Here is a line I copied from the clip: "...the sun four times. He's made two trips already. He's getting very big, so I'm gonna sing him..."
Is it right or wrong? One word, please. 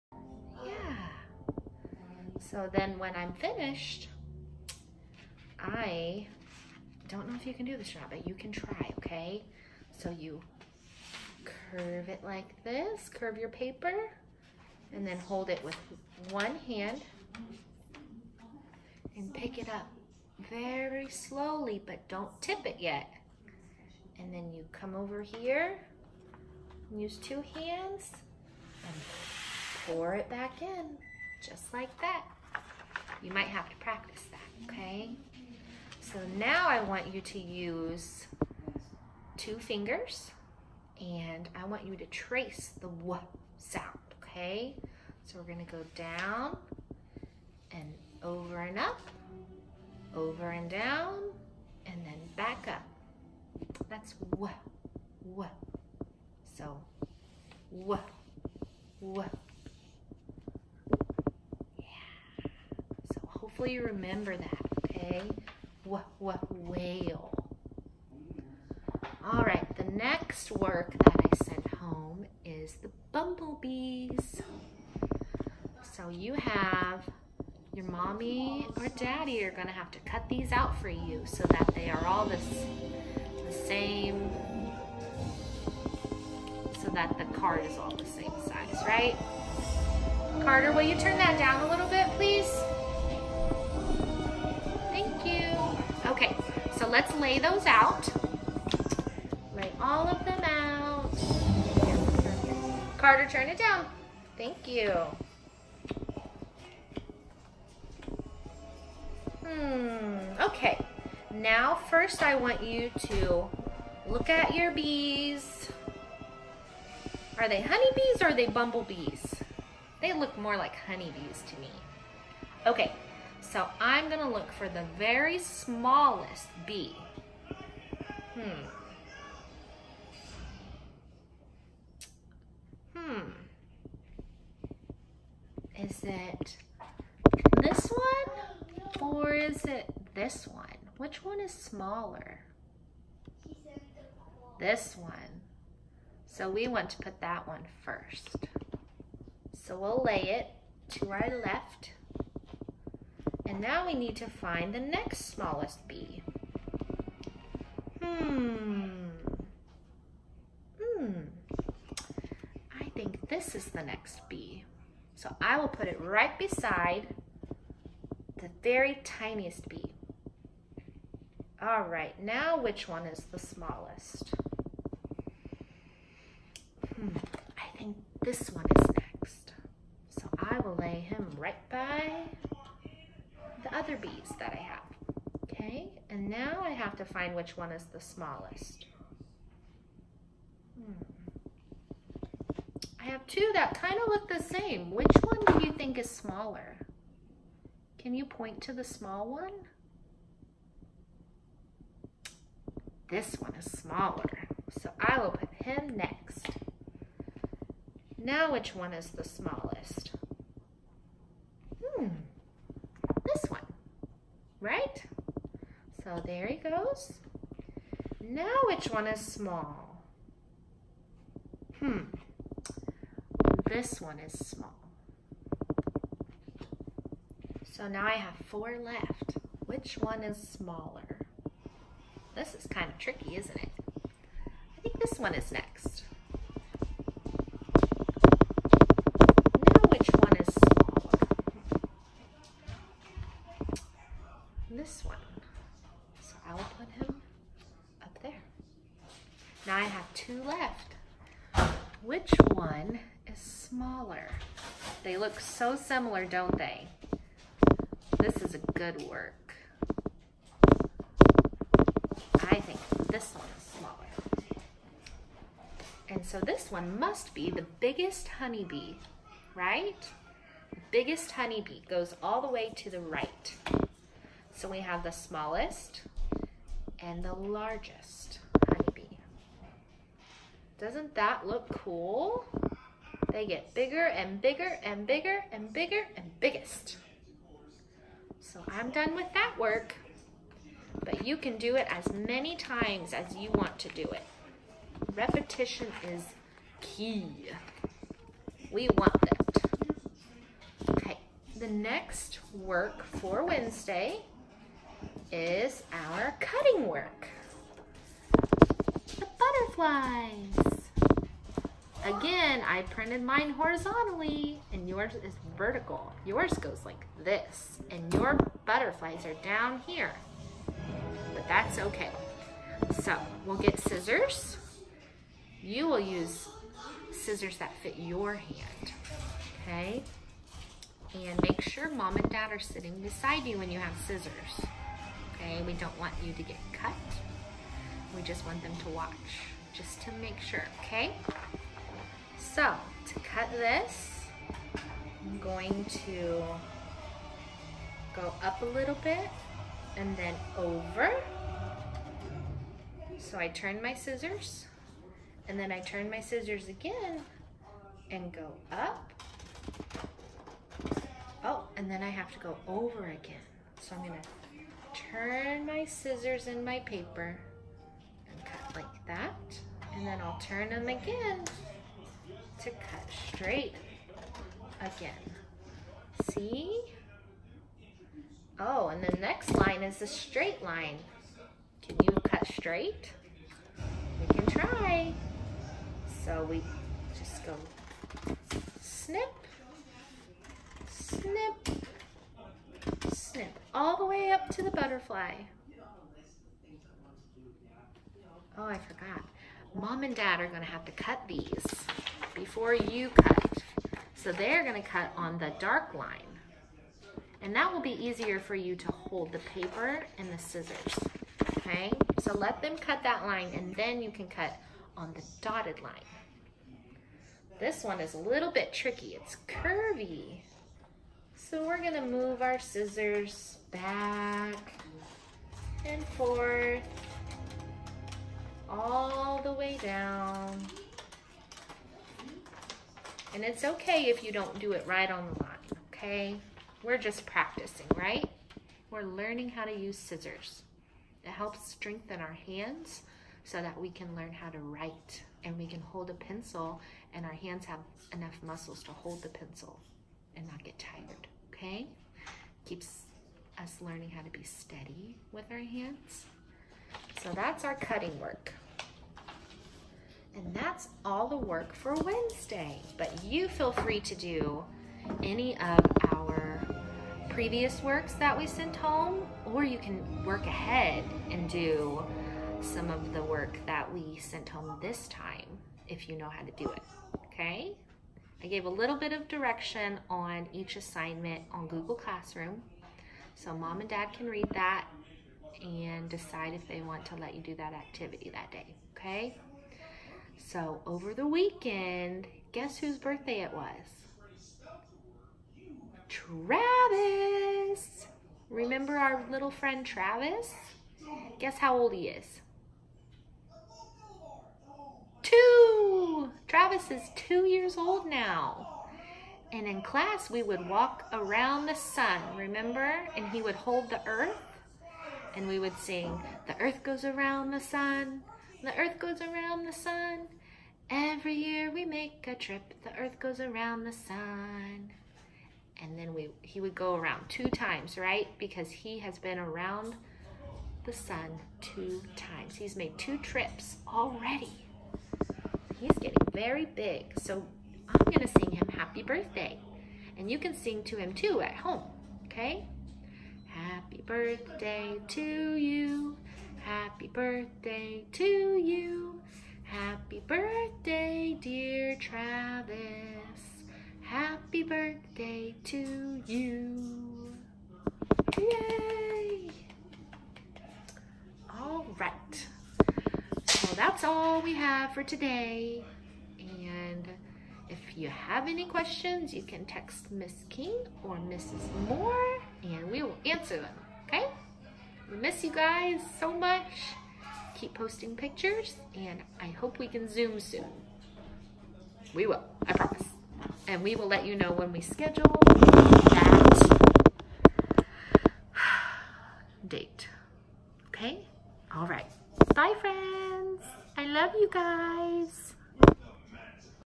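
wrong.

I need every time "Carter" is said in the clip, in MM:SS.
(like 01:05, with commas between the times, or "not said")
01:30, 01:42.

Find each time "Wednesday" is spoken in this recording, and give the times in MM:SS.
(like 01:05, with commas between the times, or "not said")
05:03, 07:41.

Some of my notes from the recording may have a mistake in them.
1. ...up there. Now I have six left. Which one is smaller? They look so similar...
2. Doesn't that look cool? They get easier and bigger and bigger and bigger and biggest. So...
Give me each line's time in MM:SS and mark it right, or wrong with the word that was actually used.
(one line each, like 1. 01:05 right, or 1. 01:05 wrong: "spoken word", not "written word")
1. 04:08 wrong: "two", not "six"
2. 04:40 wrong: "bigger", not "easier".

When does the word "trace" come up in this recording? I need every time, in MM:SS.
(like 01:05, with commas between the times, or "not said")
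00:42.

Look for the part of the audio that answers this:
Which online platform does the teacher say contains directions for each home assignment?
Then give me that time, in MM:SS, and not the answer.
08:01.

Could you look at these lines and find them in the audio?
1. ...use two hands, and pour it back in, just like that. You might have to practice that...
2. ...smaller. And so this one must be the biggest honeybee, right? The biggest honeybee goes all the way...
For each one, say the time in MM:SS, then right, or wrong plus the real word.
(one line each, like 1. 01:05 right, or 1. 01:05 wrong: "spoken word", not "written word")
1. 00:26 right
2. 04:23 right.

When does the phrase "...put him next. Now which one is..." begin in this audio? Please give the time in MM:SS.
03:25.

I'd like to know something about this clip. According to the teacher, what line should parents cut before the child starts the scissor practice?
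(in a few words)
The dark line.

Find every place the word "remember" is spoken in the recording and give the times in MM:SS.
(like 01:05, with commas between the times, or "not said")
01:03, 08:18, 08:32.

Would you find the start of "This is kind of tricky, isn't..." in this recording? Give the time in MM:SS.
03:52.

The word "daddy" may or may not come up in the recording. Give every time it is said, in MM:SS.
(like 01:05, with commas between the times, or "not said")
01:18.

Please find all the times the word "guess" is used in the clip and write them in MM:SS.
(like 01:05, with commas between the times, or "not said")
08:12, 08:21.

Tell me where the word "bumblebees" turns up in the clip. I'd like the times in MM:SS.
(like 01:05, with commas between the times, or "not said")
01:13, 01:58.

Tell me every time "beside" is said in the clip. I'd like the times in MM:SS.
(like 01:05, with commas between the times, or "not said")
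02:46, 05:32.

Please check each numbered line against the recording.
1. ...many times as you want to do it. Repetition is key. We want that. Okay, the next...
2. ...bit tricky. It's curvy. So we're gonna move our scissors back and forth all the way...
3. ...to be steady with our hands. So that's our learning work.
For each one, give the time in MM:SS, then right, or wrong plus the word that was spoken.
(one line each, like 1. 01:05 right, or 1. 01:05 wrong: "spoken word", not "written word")
1. 04:52 right
2. 06:58 right
3. 07:34 wrong: "cutting", not "learning".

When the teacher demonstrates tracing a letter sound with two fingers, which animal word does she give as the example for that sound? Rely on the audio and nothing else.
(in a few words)
Whale.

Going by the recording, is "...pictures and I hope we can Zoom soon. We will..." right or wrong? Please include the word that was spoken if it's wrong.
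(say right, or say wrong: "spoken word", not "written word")
right.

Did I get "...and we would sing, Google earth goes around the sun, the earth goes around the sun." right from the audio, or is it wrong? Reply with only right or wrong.
wrong.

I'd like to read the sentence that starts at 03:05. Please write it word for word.
Okay, and now I have to find which one is the smallest.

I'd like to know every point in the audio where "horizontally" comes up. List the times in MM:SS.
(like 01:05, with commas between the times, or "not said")
05:13.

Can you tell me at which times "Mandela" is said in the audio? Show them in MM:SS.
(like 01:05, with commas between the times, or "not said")
not said.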